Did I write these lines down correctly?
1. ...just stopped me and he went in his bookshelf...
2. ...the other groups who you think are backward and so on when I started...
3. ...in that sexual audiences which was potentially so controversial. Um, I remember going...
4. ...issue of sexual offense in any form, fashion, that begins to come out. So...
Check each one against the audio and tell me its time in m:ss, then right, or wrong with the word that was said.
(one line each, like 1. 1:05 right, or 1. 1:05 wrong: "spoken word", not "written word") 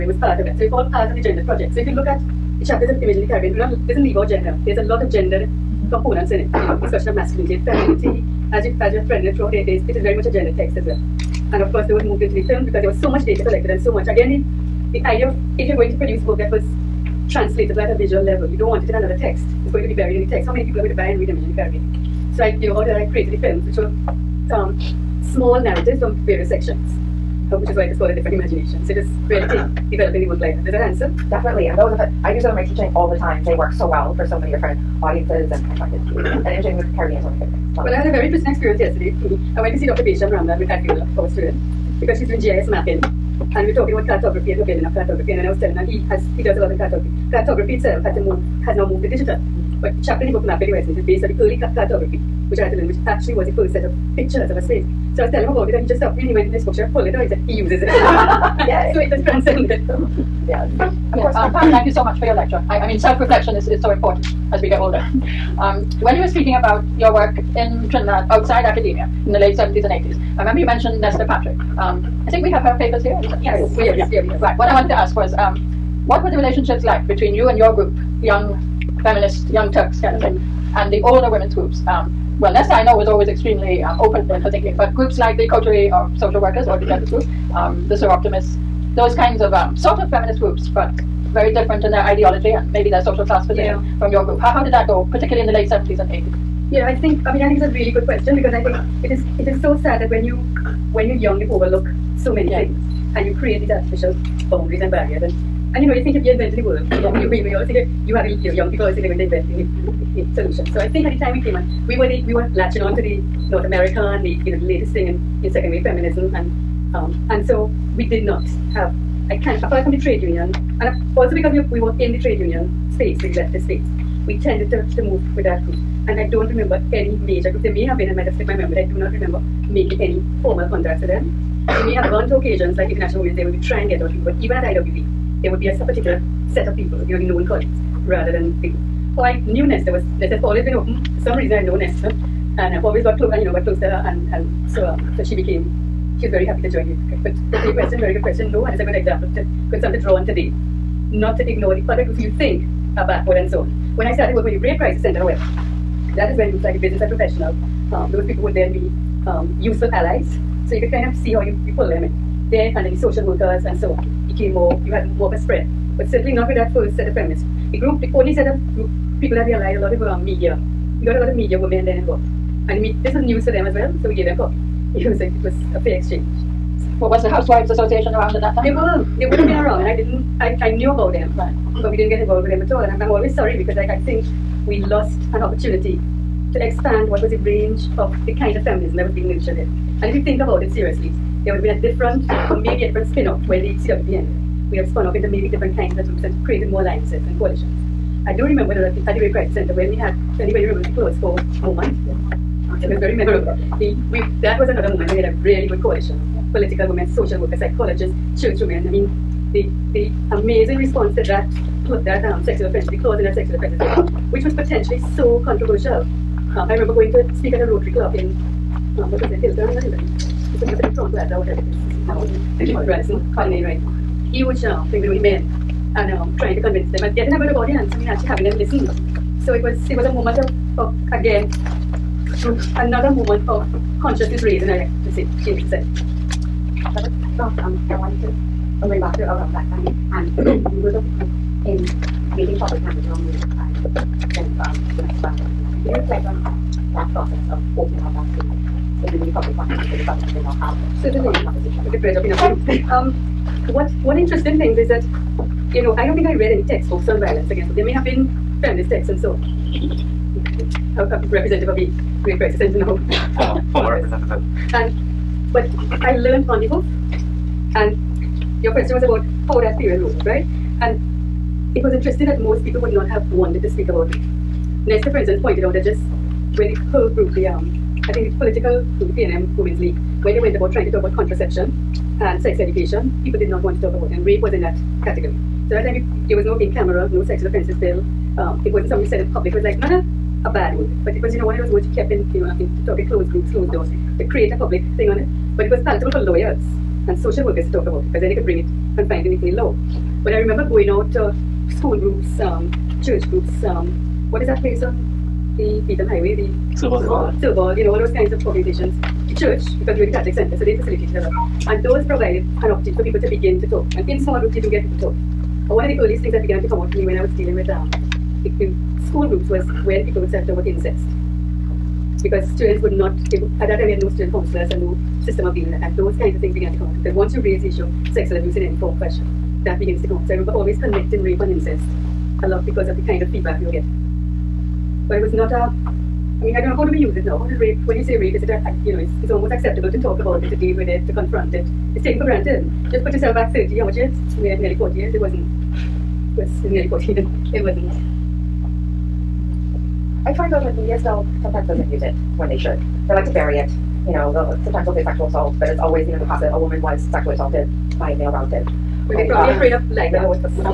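1. 0:55 right
2. 2:31 right
3. 3:33 wrong: "offenses", not "audiences"
4. 5:27 wrong: "abuse", not "offense".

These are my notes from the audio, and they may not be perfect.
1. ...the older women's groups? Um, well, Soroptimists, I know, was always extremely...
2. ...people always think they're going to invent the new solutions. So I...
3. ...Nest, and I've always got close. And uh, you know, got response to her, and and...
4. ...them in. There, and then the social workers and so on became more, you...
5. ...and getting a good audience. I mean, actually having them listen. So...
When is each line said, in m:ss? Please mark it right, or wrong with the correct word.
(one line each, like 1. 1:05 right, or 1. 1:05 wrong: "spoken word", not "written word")
1. 1:20 wrong: "Nesta", not "Soroptimists"
2. 1:48 right
3. 2:21 wrong: "close", not "response"
4. 2:41 right
5. 3:47 right.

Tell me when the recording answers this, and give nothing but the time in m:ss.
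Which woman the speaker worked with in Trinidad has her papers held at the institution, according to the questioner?
1:11.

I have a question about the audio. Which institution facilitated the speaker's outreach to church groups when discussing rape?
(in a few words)
Catholic Center.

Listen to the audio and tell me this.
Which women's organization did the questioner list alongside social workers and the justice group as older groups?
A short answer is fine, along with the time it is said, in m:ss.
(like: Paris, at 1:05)
Soroptimists, at 1:27.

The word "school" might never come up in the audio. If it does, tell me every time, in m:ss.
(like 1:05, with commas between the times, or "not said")
5:01, 5:19.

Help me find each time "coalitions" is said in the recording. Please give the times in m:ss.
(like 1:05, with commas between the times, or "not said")
3:17, 3:25.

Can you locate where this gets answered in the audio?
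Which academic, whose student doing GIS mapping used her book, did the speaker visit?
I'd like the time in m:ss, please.
0:39.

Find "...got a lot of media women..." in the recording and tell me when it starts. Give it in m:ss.
2:51.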